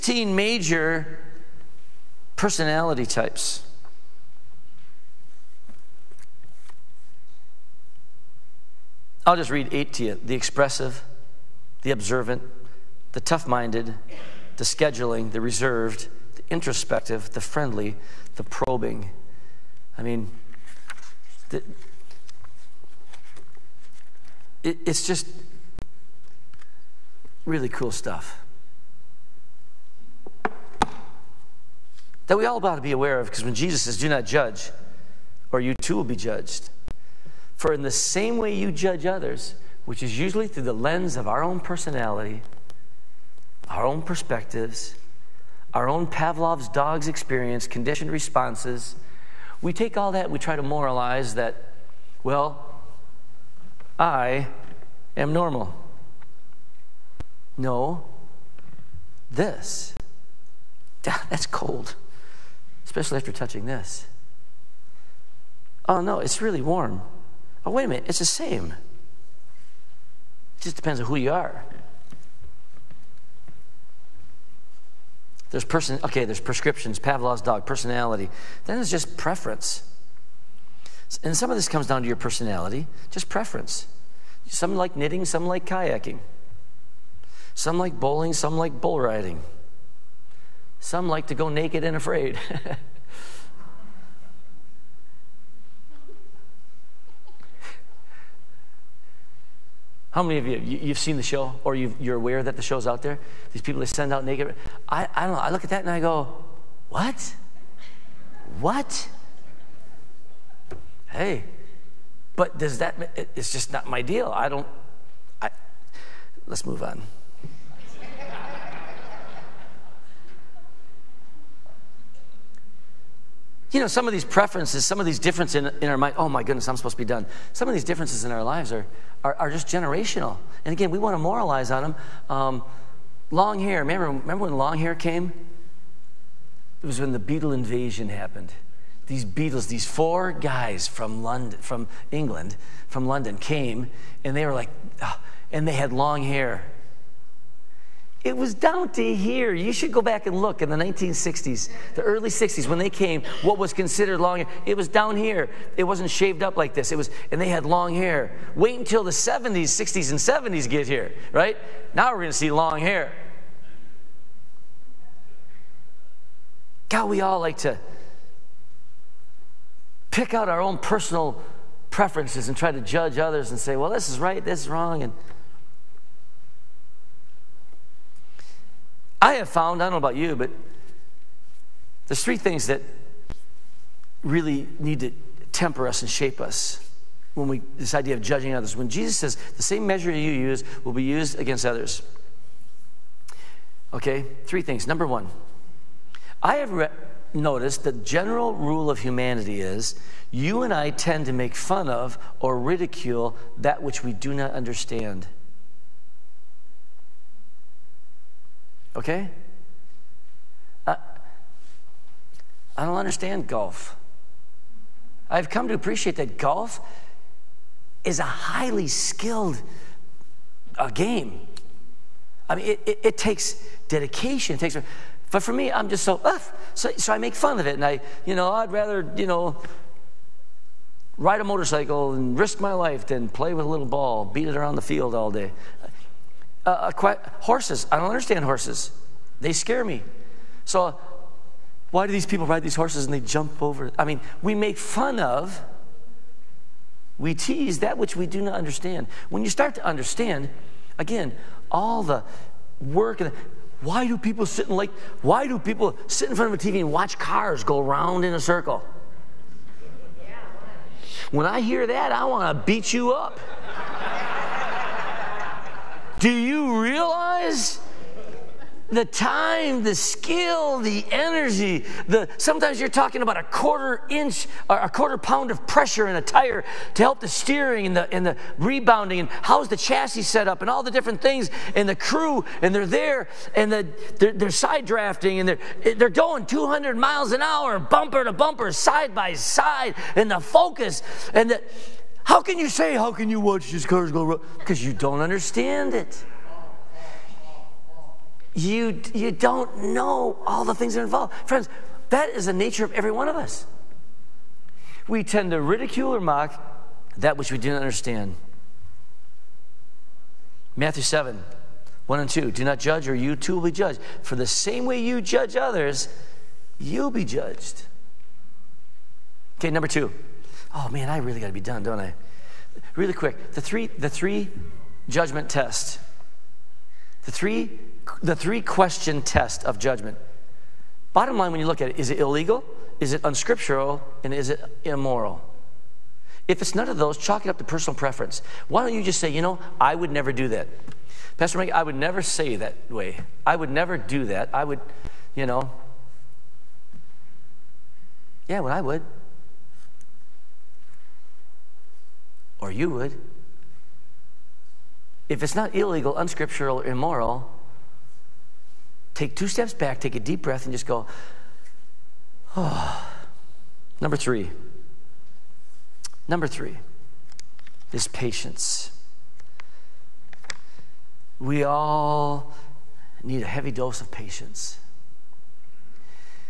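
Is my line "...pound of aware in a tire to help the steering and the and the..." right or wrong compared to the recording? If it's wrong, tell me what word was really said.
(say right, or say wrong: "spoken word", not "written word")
wrong: "pressure", not "aware".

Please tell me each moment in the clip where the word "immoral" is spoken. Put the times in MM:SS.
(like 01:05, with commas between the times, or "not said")
05:34, 05:56.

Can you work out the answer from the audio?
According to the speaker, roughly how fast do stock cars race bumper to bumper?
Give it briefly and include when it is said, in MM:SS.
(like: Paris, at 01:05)
200 miles an hour, at 04:46.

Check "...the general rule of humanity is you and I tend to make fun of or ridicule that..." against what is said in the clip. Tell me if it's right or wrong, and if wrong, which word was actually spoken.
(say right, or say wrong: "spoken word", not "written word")
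right.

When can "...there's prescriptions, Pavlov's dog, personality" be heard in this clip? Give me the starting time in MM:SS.
01:16.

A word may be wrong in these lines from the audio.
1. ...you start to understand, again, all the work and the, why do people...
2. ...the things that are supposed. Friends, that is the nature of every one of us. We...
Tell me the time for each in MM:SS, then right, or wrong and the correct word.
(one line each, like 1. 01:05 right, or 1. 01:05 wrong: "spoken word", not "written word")
1. 04:09 right
2. 05:00 wrong: "involved", not "supposed".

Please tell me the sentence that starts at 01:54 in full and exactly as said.
I don't, I, let's move on.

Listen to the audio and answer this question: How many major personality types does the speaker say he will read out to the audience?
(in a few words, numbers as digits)
8.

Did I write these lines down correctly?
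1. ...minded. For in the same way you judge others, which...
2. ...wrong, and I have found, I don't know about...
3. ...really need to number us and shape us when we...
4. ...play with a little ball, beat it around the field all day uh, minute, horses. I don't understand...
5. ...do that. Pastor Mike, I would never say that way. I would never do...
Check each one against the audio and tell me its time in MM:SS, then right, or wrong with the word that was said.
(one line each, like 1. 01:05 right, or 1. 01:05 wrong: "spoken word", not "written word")
1. 00:36 wrong: "judged", not "minded"
2. 02:54 right
3. 03:04 wrong: "temper", not "number"
4. 03:53 wrong: "quite", not "minute"
5. 05:40 right.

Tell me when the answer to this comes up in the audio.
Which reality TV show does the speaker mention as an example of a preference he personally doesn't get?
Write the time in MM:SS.
01:31.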